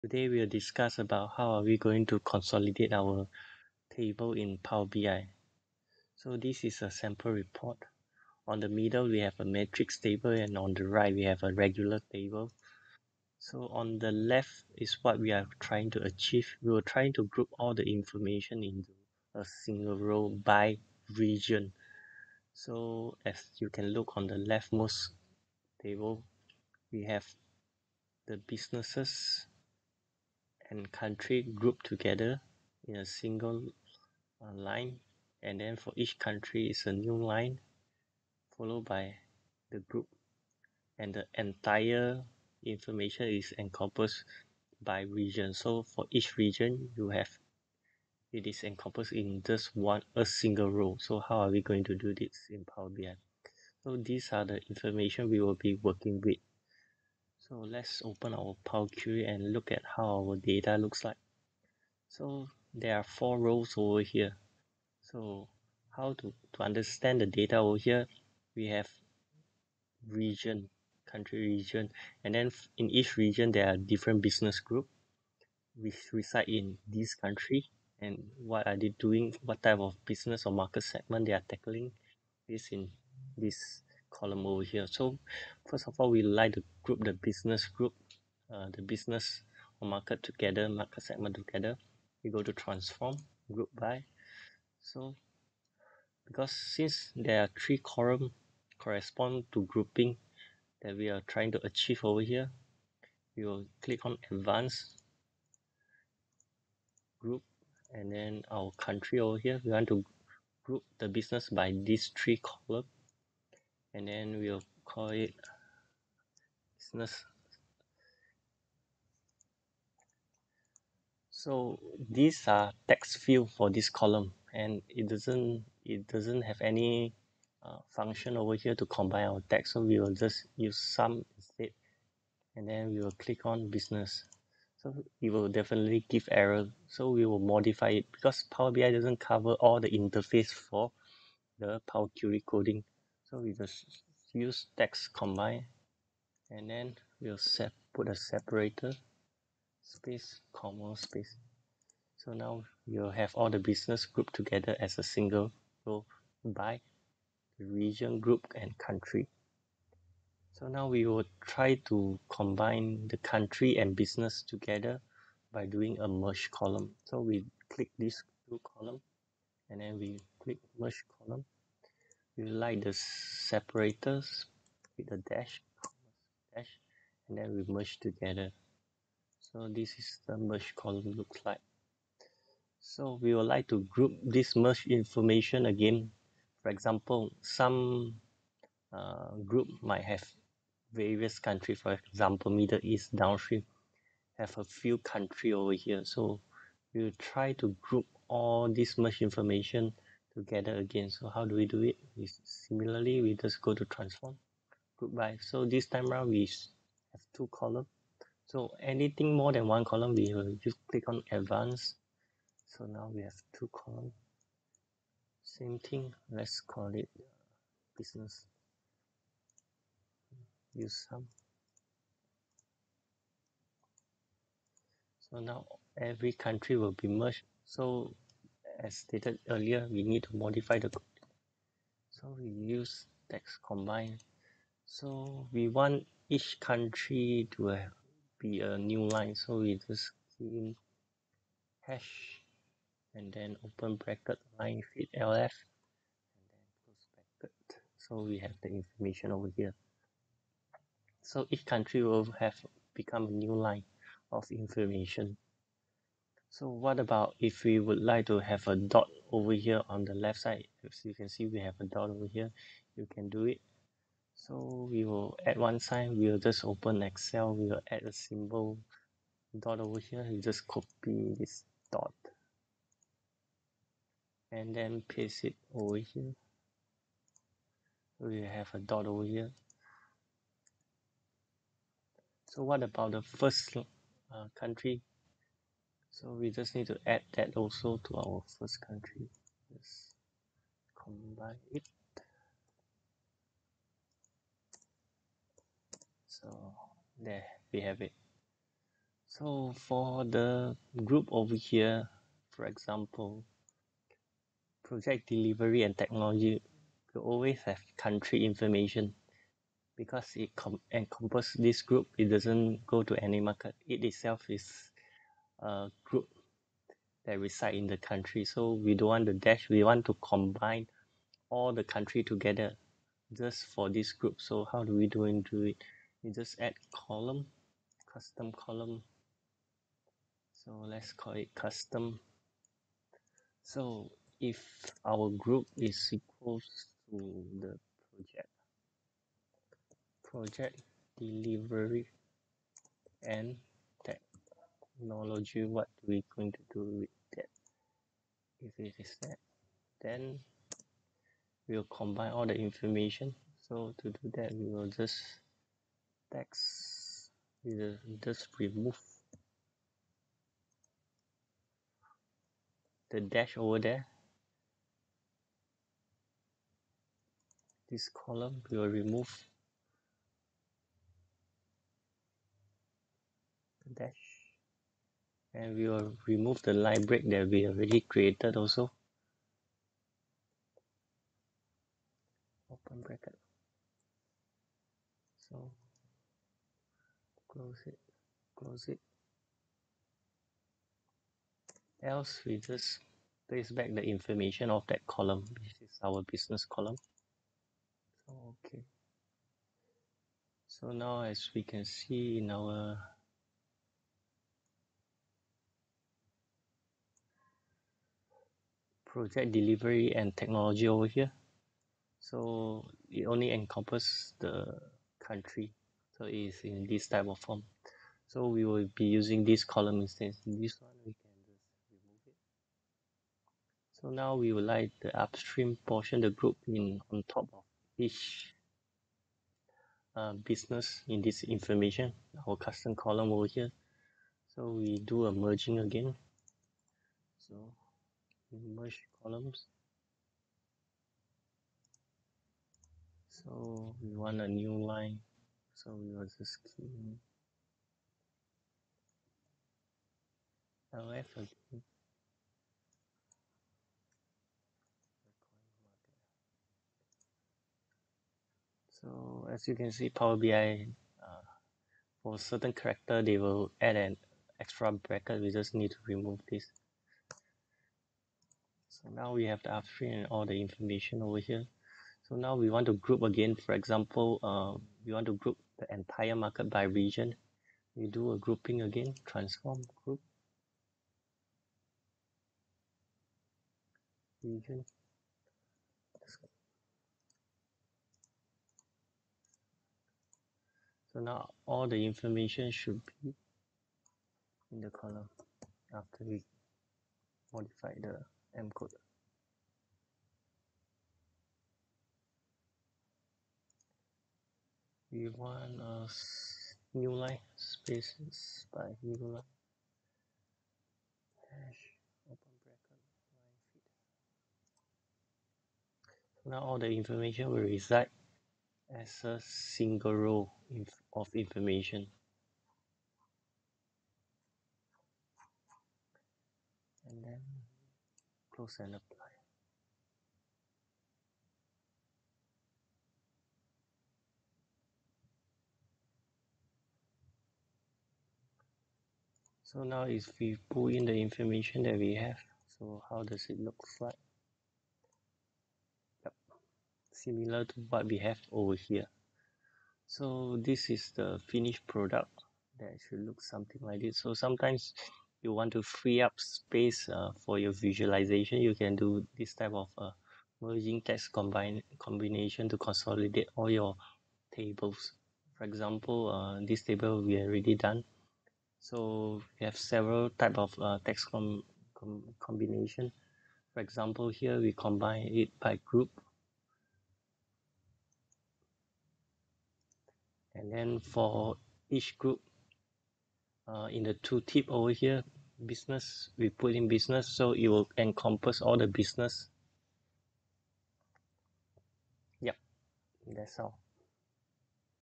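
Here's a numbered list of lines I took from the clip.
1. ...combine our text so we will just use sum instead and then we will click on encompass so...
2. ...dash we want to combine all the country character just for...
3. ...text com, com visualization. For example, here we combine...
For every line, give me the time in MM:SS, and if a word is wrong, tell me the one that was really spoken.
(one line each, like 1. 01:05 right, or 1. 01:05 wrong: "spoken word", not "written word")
1. 02:08 wrong: "business", not "encompass"
2. 05:19 wrong: "together", not "character"
3. 09:31 wrong: "combination", not "visualization".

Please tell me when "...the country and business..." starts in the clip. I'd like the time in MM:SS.
02:43.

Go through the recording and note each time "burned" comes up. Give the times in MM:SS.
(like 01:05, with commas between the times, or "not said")
not said.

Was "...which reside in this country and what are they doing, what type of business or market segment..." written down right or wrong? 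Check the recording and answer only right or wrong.
right.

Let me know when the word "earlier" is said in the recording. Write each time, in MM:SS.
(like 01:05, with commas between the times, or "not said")
03:49.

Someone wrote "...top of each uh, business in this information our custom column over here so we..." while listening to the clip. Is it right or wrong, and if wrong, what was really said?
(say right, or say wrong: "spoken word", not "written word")
right.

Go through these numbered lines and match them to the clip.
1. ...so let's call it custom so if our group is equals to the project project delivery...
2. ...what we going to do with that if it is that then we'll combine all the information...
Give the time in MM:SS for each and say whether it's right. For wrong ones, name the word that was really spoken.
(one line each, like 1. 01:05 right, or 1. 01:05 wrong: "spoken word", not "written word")
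1. 05:30 right
2. 05:45 right.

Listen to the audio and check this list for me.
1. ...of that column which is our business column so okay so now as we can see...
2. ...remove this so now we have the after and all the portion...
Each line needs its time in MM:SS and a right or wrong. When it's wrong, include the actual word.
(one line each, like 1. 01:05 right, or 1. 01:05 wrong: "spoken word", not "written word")
1. 06:34 right
2. 07:46 wrong: "information", not "portion".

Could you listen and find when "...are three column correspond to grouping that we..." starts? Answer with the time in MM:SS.
01:37.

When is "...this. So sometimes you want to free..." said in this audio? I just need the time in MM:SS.
09:14.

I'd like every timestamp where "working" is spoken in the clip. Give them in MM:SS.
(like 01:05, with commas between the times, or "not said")
00:55.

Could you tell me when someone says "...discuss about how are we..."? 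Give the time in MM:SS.
00:00.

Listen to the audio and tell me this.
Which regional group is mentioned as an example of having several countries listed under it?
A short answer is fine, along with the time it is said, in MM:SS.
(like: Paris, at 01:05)
Middle East downstream, at 03:12.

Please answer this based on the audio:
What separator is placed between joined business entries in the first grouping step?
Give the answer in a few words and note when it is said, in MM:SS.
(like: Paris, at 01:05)
Space comma space, at 02:29.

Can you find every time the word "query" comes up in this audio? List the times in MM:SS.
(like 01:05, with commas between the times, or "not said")
00:58, 02:22.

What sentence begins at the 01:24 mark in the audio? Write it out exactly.
So first of all, we like to group the business group, uh, the business or market together, market segment together.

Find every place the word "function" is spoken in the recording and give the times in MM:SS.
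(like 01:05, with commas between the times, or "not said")
02:07.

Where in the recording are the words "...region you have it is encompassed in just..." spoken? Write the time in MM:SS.
00:46.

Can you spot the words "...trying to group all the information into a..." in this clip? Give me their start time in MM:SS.
00:16.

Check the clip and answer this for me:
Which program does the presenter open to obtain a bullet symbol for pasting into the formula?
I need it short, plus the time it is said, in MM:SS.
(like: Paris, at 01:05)
Excel, at 04:27.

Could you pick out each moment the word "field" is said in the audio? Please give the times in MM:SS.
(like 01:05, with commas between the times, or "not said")
02:03.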